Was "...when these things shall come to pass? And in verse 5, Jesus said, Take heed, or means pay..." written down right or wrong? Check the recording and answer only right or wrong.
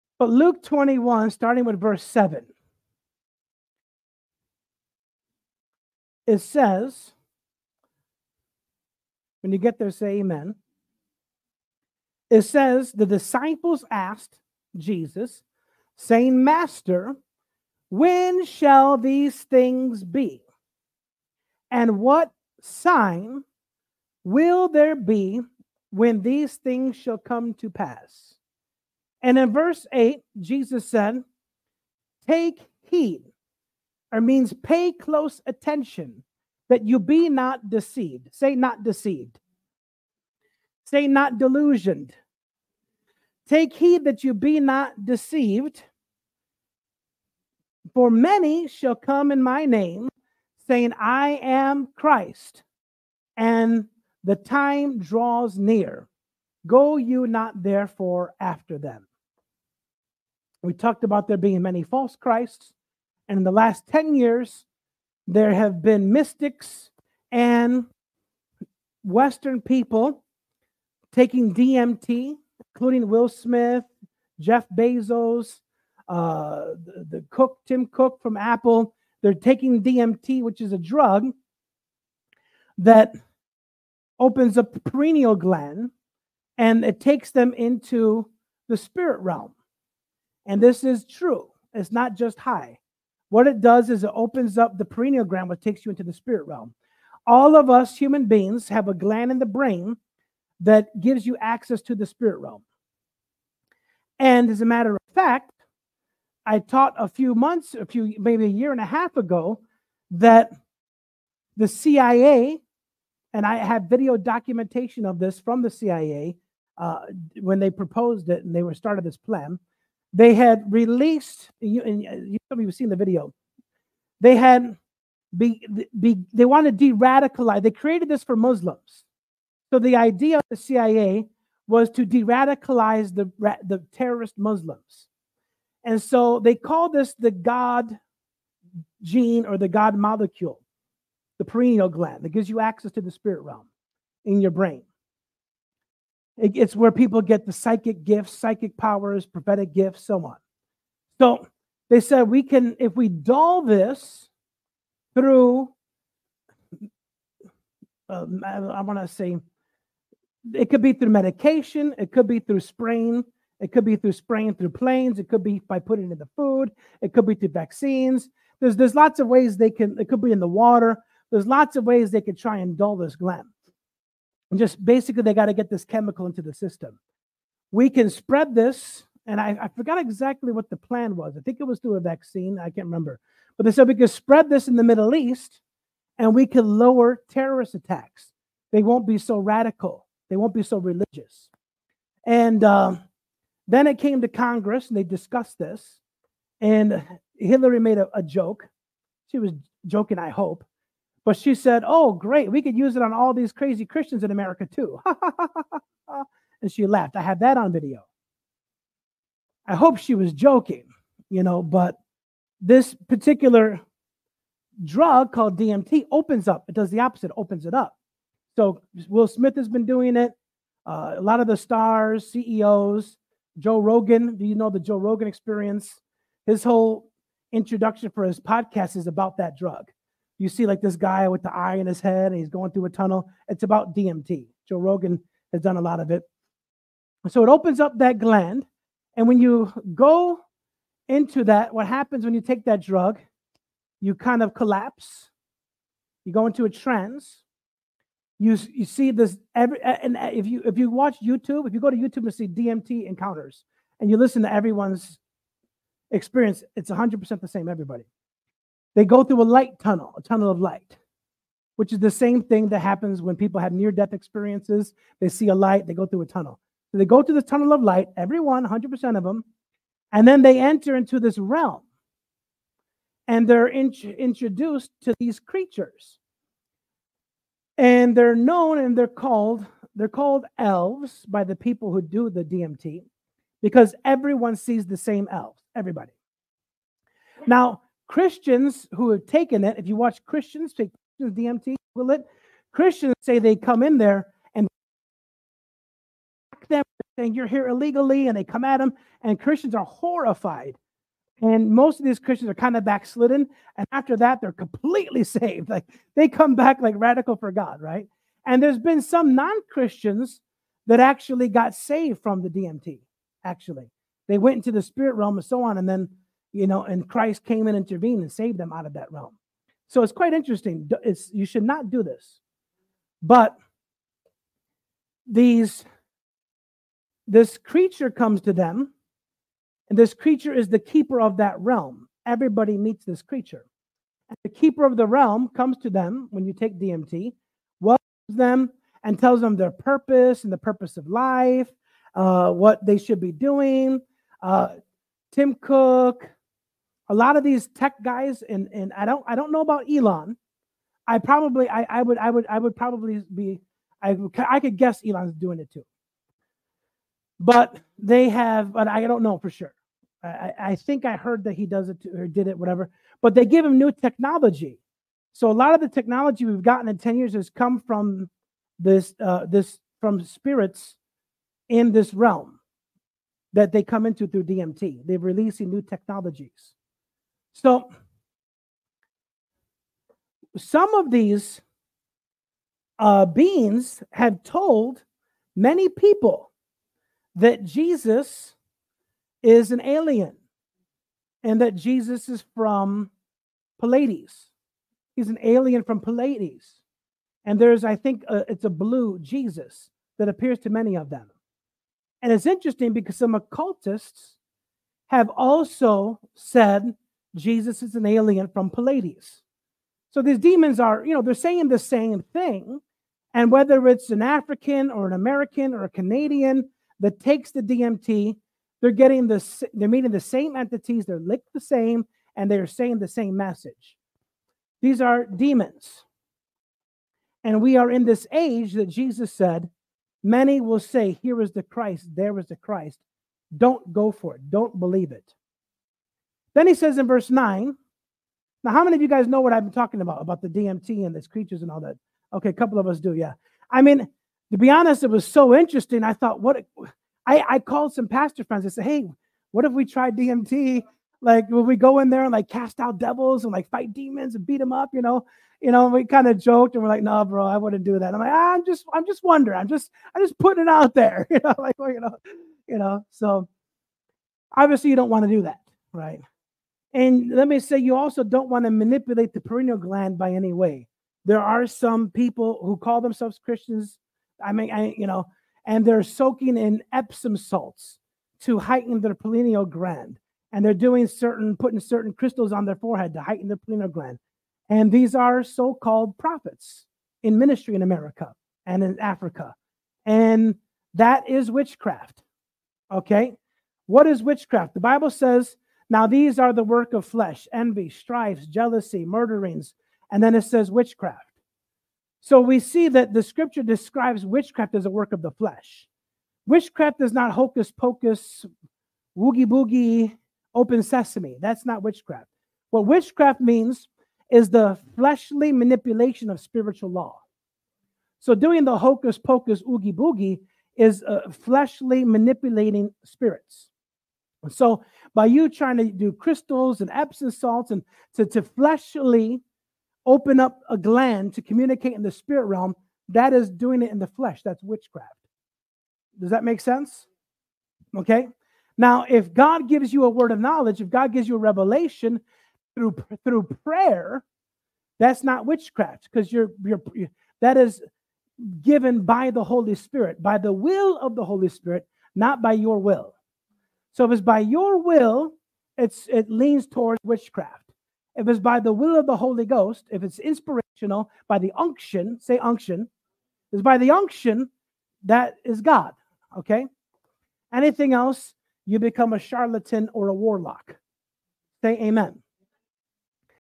wrong.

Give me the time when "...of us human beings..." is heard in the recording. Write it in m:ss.
1:37.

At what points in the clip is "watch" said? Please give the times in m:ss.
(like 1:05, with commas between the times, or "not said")
4:10, 4:49.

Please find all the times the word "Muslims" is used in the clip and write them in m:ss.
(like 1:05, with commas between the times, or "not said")
2:08, 2:14.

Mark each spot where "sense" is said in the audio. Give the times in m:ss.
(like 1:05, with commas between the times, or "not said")
8:56.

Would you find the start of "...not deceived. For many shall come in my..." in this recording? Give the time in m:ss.
0:44.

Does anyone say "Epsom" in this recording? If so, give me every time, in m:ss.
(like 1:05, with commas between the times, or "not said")
7:56, 8:46.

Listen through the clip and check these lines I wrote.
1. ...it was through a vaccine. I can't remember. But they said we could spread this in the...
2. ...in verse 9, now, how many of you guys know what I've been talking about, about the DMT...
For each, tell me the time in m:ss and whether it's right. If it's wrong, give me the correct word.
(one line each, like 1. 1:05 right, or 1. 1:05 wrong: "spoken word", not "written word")
1. 3:01 right
2. 7:16 right.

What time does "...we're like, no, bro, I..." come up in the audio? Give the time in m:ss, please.
7:36.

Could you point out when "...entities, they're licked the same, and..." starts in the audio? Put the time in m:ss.
7:00.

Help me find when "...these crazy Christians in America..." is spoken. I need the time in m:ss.
3:23.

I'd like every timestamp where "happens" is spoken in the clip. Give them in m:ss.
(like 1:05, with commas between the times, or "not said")
4:01, 4:22.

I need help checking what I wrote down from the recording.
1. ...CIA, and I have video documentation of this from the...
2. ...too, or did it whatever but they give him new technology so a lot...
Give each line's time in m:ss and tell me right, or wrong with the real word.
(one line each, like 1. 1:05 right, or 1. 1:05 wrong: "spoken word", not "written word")
1. 1:51 right
2. 6:02 right.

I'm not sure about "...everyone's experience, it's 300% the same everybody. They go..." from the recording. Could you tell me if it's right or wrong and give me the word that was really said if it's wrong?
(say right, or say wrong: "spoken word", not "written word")
wrong: "100", not "300".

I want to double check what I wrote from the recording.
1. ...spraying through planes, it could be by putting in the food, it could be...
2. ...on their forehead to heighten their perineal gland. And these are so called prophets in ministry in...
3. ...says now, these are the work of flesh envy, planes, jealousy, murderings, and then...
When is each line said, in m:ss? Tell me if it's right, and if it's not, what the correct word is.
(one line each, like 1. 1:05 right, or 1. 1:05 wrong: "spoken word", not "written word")
1. 2:44 right
2. 8:02 wrong: "pineal", not "perineal"
3. 8:15 wrong: "strifes", not "planes".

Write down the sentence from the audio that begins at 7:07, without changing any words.
And we are in this age that Jesus said, many will say, Here is the Christ, there is the Christ.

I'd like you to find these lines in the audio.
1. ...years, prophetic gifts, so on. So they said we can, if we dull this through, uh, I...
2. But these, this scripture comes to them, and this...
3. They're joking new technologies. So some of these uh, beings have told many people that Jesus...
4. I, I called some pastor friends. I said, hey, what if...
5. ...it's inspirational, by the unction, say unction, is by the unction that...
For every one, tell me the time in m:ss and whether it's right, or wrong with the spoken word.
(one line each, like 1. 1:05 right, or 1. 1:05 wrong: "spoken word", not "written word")
1. 2:28 wrong: "powers", not "years"
2. 5:23 wrong: "creature", not "scripture"
3. 6:15 wrong: "releasing", not "joking"
4. 7:27 right
5. 9:20 right.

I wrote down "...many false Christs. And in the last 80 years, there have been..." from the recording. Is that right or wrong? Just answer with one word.
wrong.